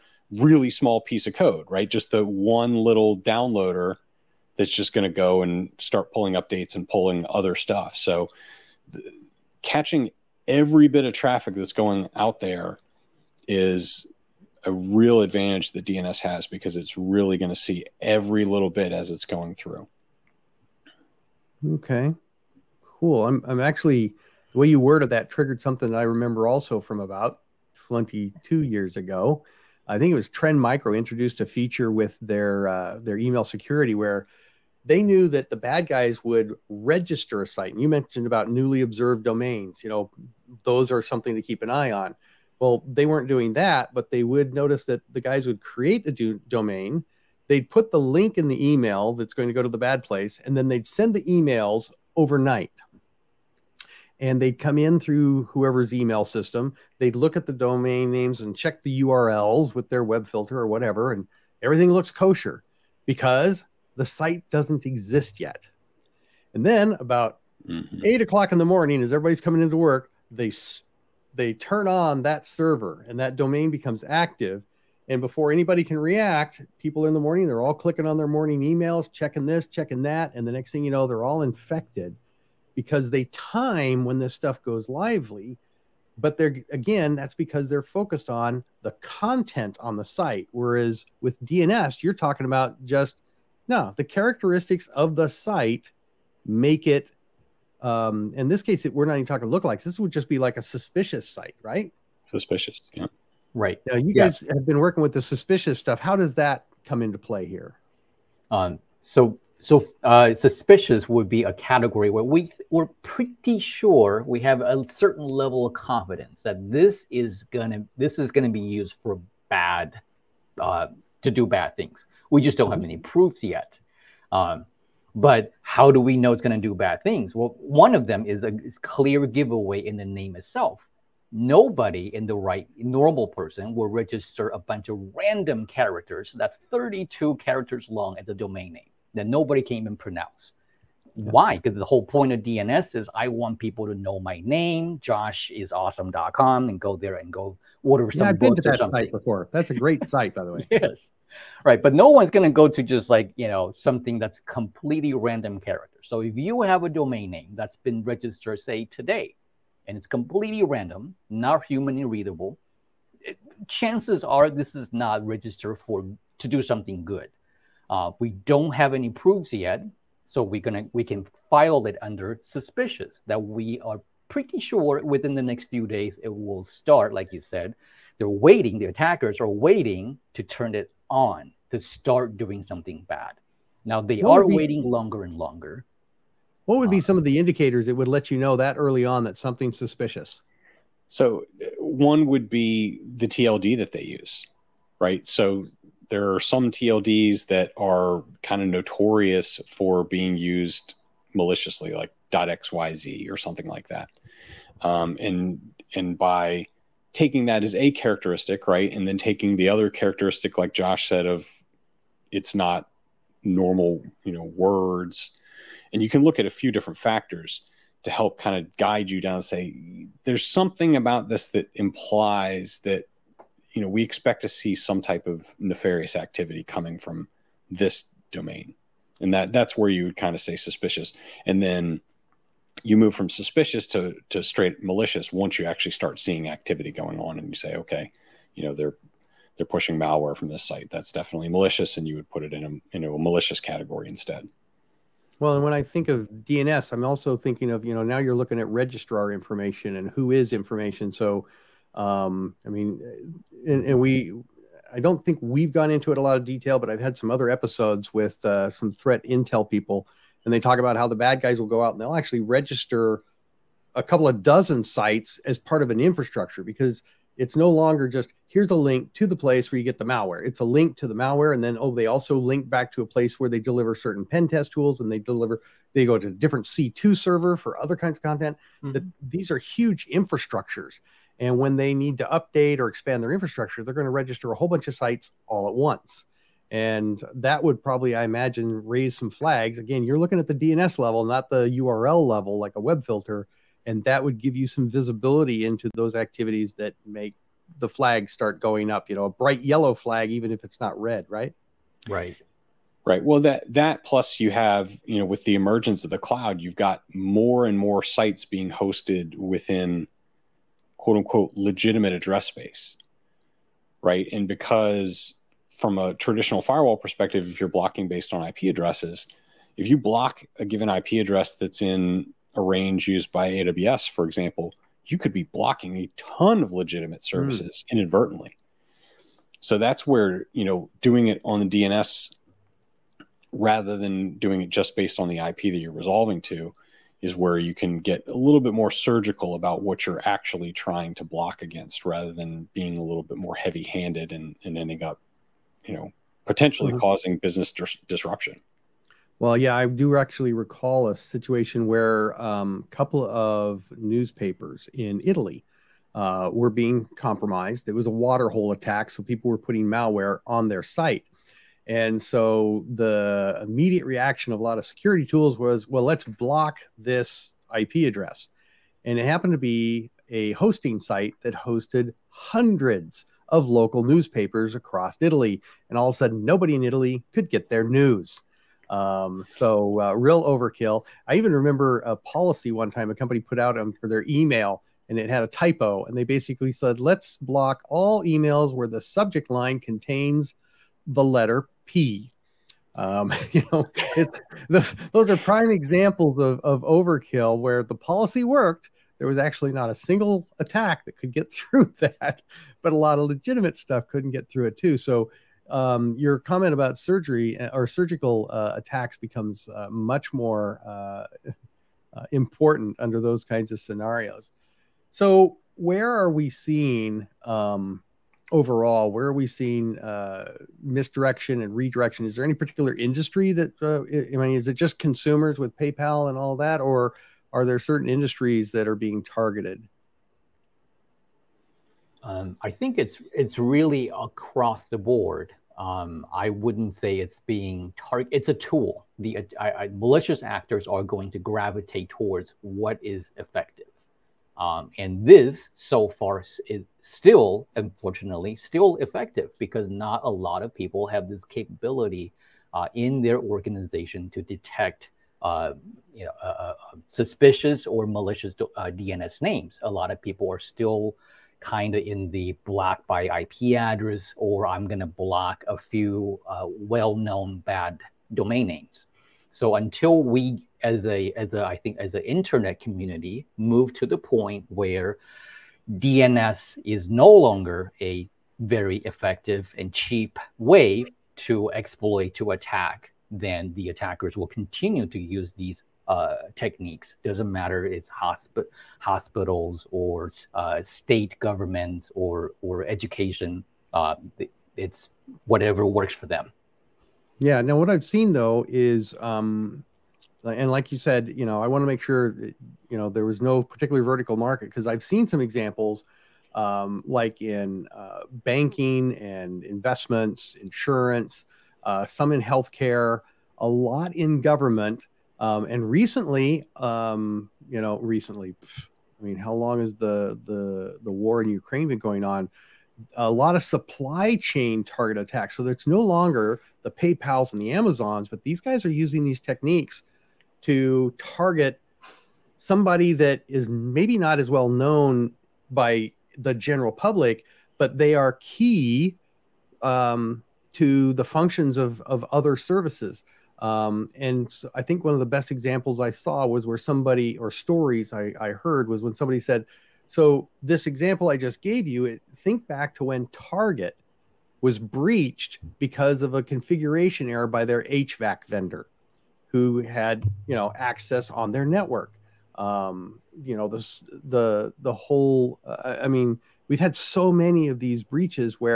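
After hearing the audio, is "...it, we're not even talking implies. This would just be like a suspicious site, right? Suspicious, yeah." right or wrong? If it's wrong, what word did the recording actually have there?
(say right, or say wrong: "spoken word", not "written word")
wrong: "lookalikes", not "implies".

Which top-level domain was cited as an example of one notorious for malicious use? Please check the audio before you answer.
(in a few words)
xyz.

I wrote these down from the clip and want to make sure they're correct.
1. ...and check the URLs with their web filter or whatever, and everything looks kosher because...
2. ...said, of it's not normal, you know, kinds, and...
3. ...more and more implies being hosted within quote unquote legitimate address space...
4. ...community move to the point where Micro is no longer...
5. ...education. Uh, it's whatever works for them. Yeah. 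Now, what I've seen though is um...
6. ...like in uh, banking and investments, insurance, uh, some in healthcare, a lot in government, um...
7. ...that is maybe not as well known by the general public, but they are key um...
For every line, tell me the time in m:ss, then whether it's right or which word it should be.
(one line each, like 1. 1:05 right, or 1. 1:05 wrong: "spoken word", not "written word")
1. 0:58 right
2. 3:31 wrong: "words", not "kinds"
3. 5:07 wrong: "sites", not "implies"
4. 7:52 wrong: "DNS", not "Micro"
5. 8:12 right
6. 8:27 right
7. 8:53 right.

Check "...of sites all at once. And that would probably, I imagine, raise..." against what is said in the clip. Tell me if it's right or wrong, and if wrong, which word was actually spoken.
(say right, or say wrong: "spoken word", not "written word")
right.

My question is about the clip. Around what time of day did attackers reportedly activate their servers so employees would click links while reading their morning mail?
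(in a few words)
8 o'clock in the morning.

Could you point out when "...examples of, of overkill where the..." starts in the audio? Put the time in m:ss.
6:35.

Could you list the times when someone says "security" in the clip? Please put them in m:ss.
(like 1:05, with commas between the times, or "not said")
0:33, 6:04.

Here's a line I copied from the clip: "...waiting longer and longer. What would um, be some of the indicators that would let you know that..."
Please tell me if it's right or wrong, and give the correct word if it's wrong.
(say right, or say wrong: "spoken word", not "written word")
right.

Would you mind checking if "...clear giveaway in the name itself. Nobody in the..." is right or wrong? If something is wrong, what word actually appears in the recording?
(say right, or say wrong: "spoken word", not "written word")
right.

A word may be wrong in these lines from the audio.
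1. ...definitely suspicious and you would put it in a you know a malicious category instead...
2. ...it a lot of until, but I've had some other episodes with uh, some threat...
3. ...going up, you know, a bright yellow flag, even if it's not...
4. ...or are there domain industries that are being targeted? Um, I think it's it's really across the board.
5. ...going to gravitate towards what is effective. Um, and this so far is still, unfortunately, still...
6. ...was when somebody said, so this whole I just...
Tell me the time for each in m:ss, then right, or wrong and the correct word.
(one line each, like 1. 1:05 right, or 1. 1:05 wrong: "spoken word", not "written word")
1. 4:01 wrong: "malicious", not "suspicious"
2. 4:16 wrong: "detail", not "until"
3. 4:58 right
4. 7:06 wrong: "certain", not "domain"
5. 7:21 right
6. 9:08 wrong: "example", not "whole".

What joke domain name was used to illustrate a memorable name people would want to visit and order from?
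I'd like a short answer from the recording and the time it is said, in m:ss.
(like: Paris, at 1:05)
Josh is awesome.com, at 2:24.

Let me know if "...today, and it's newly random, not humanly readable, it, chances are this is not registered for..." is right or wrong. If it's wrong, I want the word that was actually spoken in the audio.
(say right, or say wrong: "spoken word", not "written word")
wrong: "completely", not "newly".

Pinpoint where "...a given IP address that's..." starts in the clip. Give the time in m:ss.
5:20.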